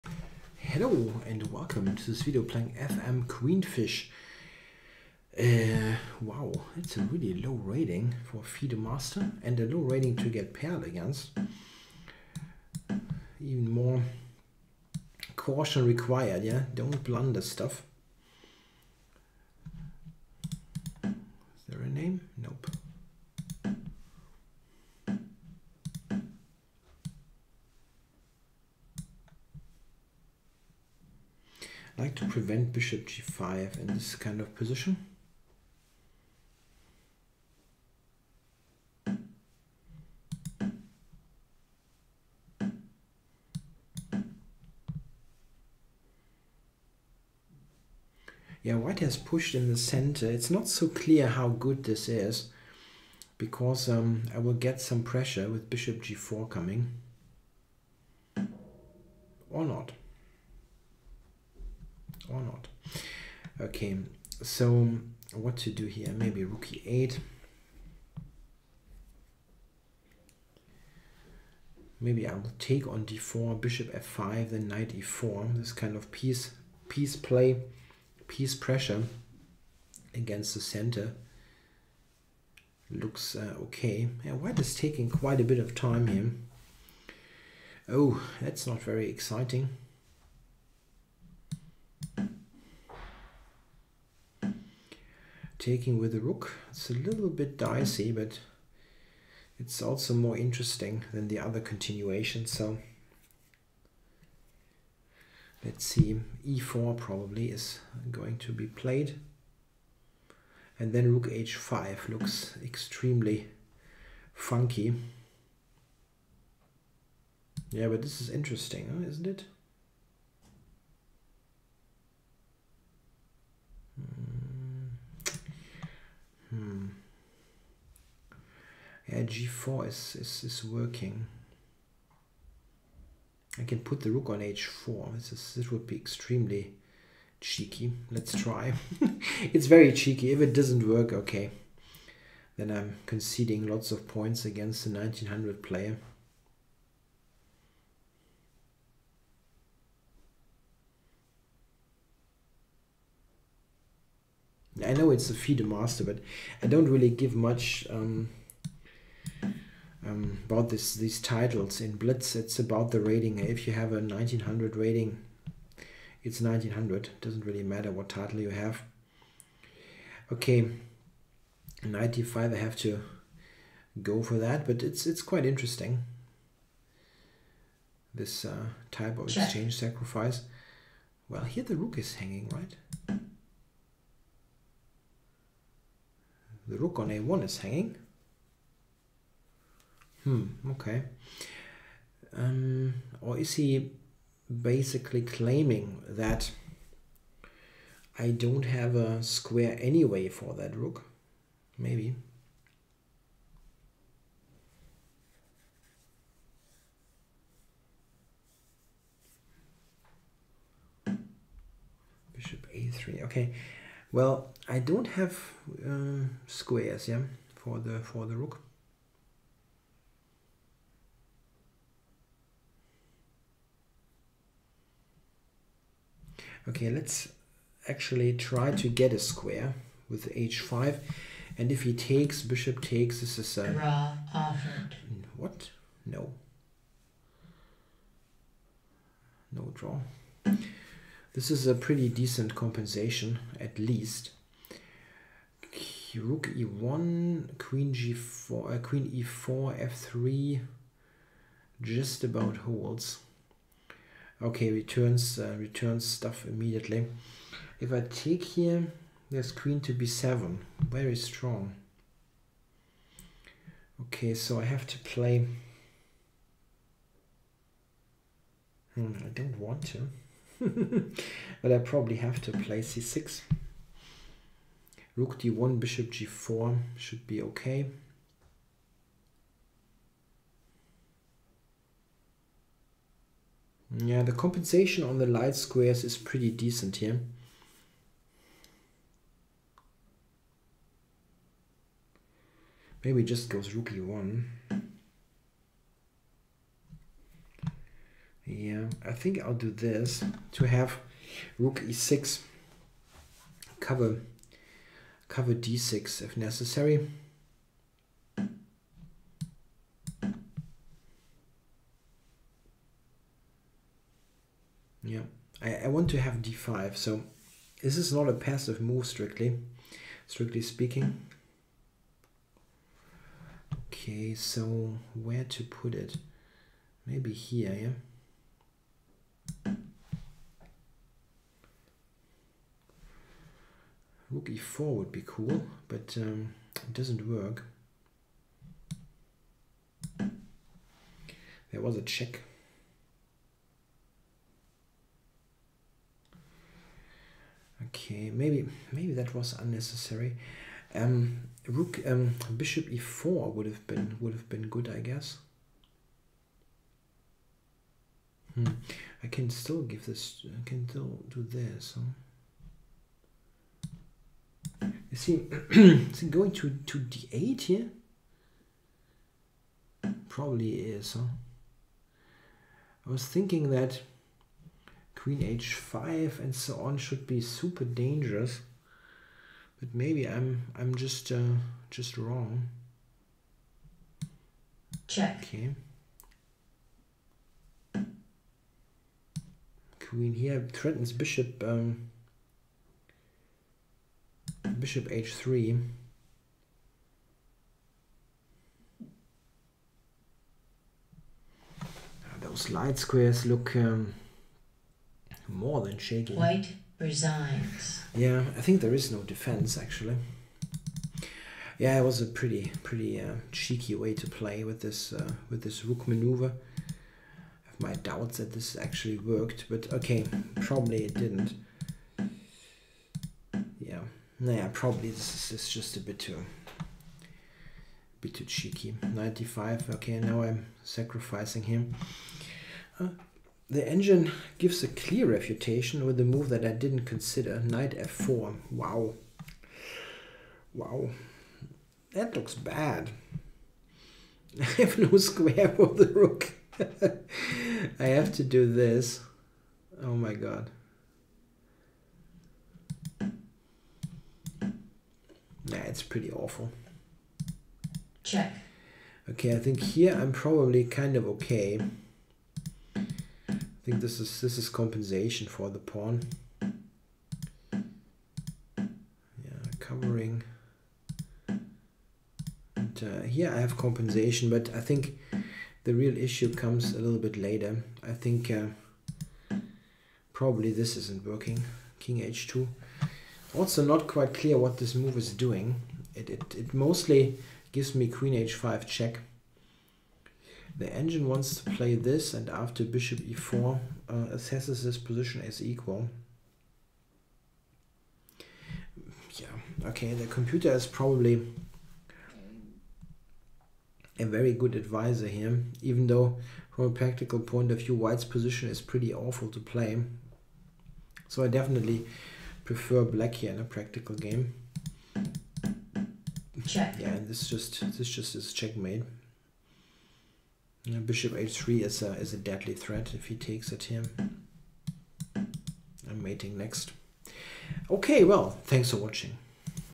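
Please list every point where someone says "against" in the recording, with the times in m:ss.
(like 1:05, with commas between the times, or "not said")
0:10, 1:20, 2:24.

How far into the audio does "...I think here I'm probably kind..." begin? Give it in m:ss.
7:39.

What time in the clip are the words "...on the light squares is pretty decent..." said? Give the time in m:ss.
4:45.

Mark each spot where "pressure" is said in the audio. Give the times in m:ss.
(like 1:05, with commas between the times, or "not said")
0:55, 1:18.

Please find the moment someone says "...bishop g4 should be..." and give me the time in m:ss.
4:35.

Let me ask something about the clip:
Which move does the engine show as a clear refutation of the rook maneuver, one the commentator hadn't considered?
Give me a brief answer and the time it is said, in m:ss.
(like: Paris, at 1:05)
knight f4, at 7:17.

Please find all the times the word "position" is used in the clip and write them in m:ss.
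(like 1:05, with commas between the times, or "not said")
0:34, 8:14, 8:28.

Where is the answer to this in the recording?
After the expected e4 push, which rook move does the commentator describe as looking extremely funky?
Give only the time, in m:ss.
1:51.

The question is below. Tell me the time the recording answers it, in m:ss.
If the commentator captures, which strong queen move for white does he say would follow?
4:19.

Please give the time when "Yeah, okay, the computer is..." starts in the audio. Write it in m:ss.
8:19.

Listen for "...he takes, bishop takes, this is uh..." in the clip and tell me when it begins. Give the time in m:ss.
3:51.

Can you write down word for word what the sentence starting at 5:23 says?
Okay, so where to put it?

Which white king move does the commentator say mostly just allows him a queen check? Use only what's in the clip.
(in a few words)
King h2.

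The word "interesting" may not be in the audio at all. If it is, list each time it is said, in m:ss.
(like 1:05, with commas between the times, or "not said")
1:40, 1:58, 2:55.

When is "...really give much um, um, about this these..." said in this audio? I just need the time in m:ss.
2:36.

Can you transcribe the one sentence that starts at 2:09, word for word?
Yeah, g4 is, is, is working.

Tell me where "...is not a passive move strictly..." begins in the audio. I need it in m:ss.
5:17.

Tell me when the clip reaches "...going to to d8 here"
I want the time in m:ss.
6:06.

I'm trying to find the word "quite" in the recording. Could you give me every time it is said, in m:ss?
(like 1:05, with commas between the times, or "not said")
1:25, 2:55, 8:04.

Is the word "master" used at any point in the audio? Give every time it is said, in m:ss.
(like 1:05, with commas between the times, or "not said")
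0:08, 2:35.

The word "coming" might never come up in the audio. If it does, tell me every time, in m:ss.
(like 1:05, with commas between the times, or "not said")
0:56.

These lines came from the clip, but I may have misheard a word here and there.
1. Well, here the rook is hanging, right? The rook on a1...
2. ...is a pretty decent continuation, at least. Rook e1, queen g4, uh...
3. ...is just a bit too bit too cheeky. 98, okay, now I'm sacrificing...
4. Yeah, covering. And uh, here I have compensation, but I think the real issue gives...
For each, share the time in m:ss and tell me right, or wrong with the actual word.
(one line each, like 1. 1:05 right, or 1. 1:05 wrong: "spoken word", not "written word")
1. 3:01 right
2. 4:01 wrong: "compensation", not "continuation"
3. 7:05 wrong: "95", not "98"
4. 7:47 wrong: "comes", not "gives".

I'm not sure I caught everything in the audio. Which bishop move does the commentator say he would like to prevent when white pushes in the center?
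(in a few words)
bishop g5.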